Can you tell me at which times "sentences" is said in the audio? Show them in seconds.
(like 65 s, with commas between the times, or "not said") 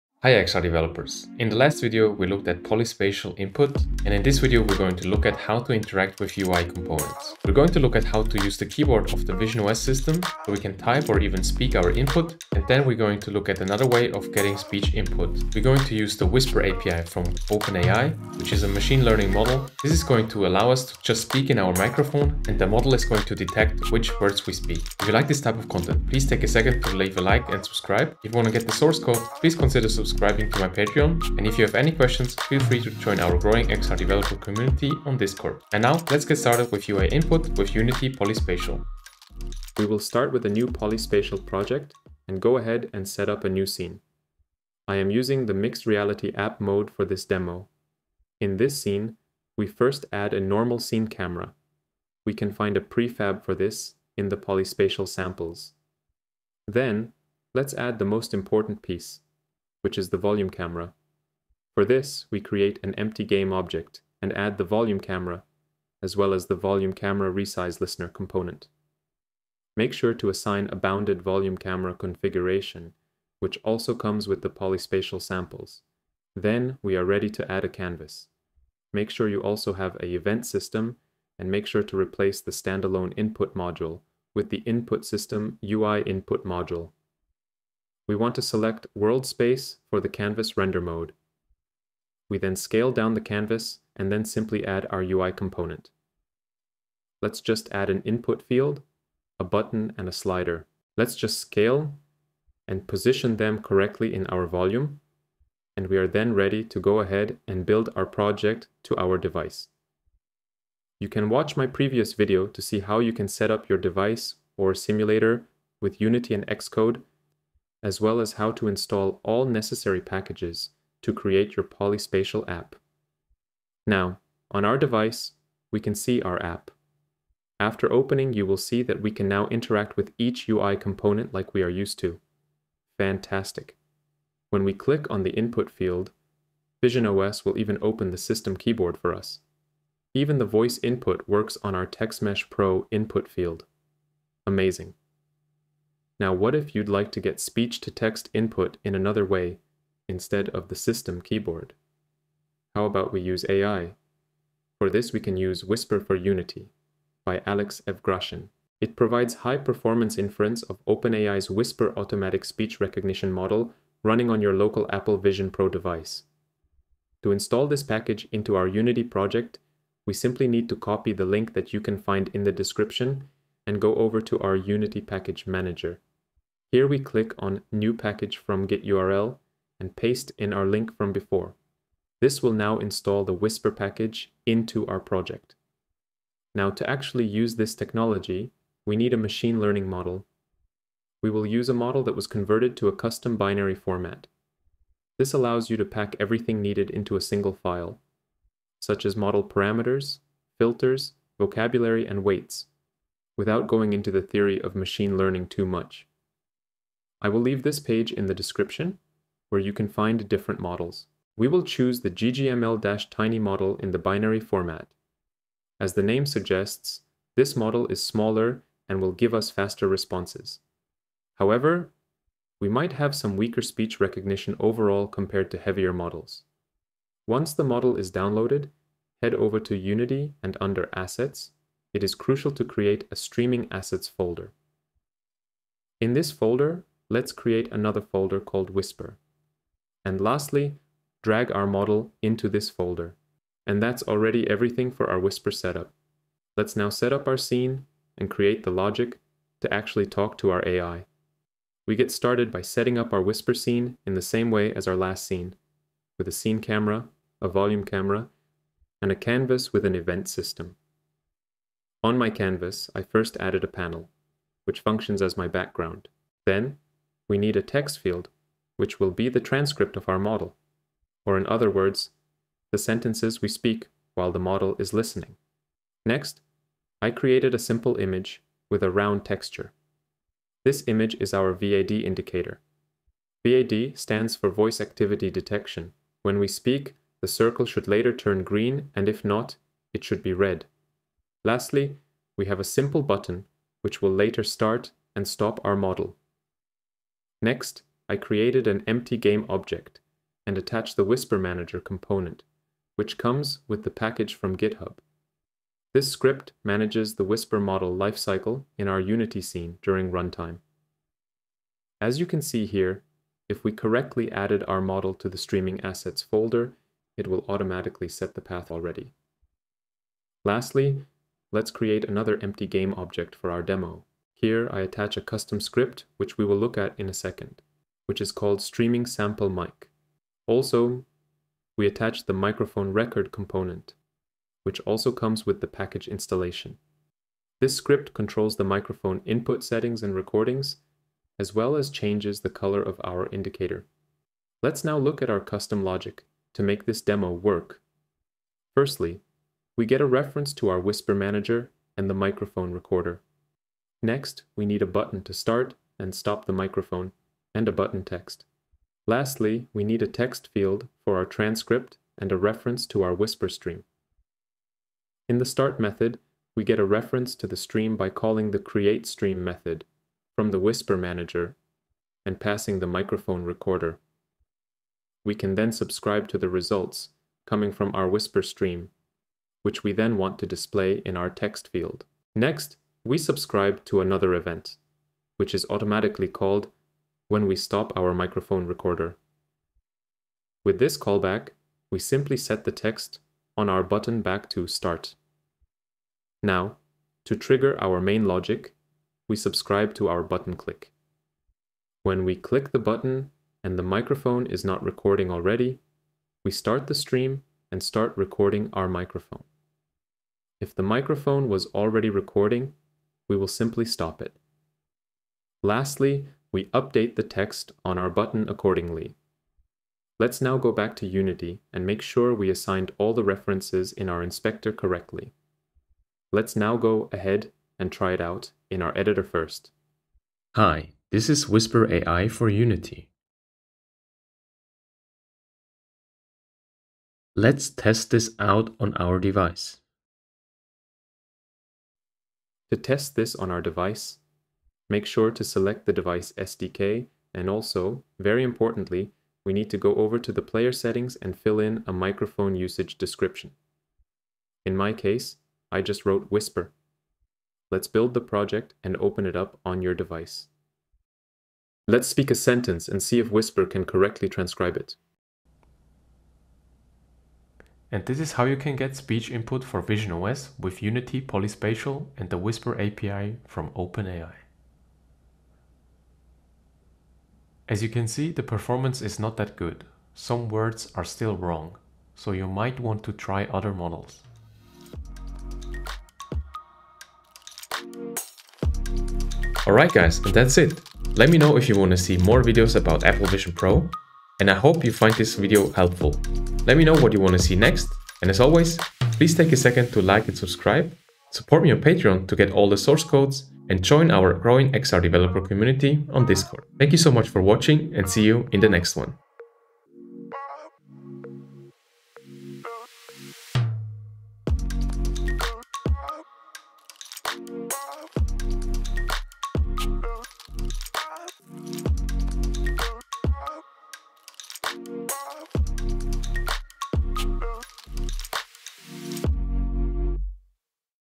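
272 s, 462 s.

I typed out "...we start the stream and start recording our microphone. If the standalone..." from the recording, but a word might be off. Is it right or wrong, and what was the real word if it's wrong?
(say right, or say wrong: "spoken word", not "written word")
wrong: "microphone", not "standalone".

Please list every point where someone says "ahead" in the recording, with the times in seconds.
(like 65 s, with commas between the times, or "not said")
42 s, 106 s, 427 s.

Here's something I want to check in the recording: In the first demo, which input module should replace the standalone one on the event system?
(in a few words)
Input system UI input module.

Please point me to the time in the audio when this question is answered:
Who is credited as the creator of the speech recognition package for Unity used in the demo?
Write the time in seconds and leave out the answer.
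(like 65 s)
157 s.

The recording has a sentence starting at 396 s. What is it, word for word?
Now, to trigger our main logic, we subscribe to our button click.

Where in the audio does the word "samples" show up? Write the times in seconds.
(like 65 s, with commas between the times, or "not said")
55 s, 75 s, 329 s.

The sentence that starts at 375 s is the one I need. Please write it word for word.
We can then subscribe to the results coming from our whisper stream, which we then want to display in our text field.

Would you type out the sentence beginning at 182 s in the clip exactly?
This will now install the Whisper package into our project.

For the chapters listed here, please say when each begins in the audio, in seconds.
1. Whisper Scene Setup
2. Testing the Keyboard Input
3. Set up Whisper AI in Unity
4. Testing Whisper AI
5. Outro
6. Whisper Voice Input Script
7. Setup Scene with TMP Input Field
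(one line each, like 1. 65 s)
1. 246 s
2. 123 s
3. 145 s
4. 429 s
5. 488 s
6. 344 s
7. 39 s.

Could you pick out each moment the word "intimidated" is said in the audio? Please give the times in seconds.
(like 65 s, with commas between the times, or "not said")
not said.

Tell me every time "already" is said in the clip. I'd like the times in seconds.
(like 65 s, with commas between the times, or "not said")
244 s, 318 s, 405 s, 411 s.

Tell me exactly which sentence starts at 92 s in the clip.
We then scale down the canvas and then simply add our UI component.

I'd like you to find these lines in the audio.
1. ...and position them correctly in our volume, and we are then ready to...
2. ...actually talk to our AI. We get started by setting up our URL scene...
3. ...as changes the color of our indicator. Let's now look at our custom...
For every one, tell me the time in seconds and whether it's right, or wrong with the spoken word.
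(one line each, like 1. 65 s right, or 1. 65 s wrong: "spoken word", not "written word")
1. 102 s right
2. 249 s wrong: "Whisper", not "URL"
3. 341 s right.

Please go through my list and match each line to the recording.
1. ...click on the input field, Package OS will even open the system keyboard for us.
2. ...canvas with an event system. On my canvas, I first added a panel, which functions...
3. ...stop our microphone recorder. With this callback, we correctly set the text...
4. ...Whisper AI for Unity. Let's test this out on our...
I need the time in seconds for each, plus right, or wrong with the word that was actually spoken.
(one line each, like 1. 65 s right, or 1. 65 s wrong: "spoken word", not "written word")
1. 134 s wrong: "Vision", not "Package"
2. 259 s right
3. 387 s wrong: "simply", not "correctly"
4. 431 s right.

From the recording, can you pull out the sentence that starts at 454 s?
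In my case, I just wrote Whisper.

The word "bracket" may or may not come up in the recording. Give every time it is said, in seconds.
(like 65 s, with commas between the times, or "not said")
not said.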